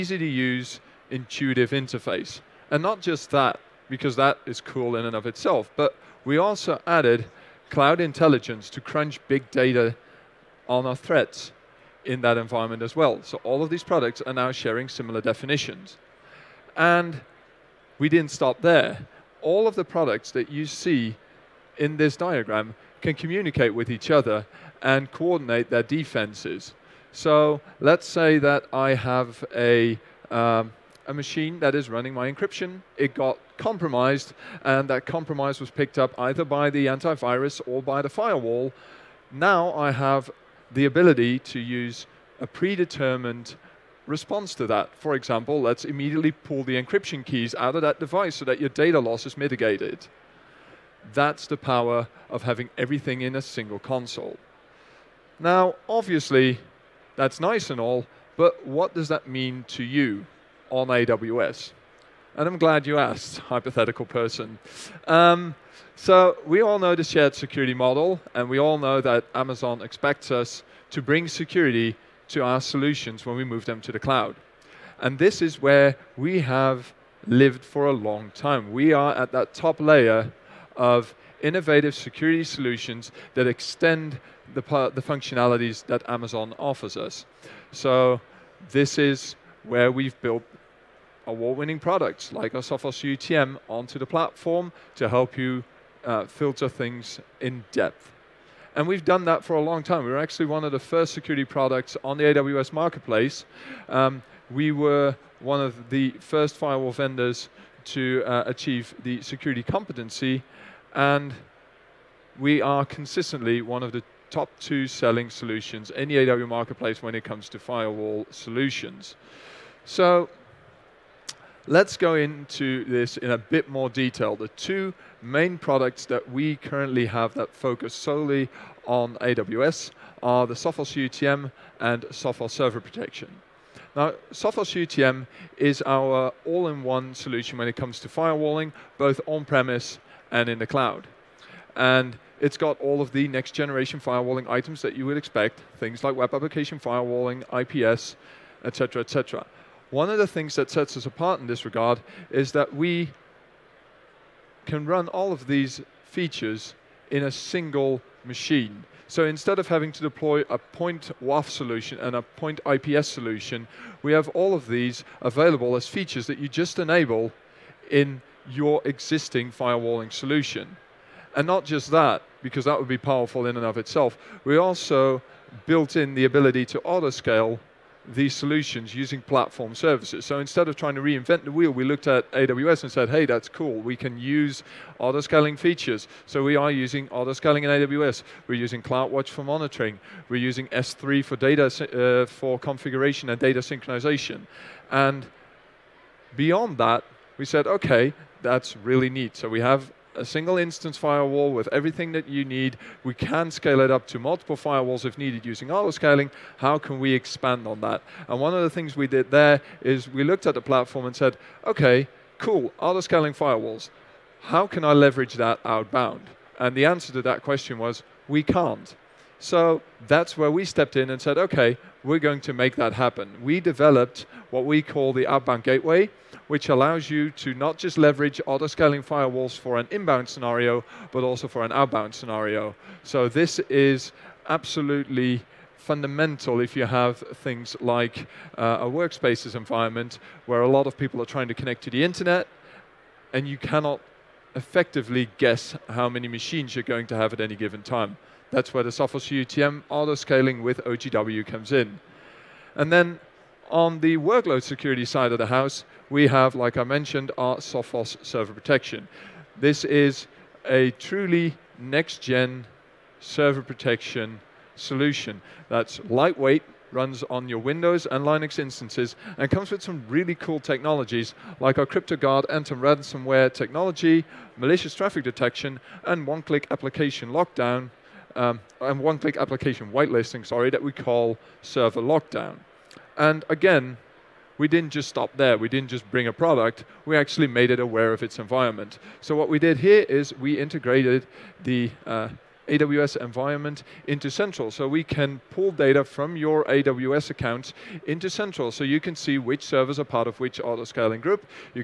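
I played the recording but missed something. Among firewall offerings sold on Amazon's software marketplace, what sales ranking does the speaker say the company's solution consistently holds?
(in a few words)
Top two.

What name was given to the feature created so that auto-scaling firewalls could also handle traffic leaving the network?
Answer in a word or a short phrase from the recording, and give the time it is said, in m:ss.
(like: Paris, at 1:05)
Outbound gateway, at 3:45.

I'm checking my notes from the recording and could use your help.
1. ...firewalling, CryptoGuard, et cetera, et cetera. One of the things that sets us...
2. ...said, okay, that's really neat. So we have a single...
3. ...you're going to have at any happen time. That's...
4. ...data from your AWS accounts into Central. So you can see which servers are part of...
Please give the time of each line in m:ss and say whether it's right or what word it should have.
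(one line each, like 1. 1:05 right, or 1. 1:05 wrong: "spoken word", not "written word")
1. 2:26 wrong: "IPS", not "CryptoGuard"
2. 3:17 right
3. 4:06 wrong: "given", not "happen"
4. 4:55 right.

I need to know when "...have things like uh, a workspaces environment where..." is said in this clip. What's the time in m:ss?
3:56.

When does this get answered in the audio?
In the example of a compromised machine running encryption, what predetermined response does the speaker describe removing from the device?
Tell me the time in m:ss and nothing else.
0:46.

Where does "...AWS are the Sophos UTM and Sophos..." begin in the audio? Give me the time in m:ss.
2:09.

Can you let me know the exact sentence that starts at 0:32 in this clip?
It got compromised, and that compromise was picked up either by the antivirus or by the firewall.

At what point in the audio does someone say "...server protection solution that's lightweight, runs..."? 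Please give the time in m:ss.
4:23.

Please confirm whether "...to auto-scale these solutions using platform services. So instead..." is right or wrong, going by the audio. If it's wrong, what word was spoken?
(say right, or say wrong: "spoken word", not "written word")
right.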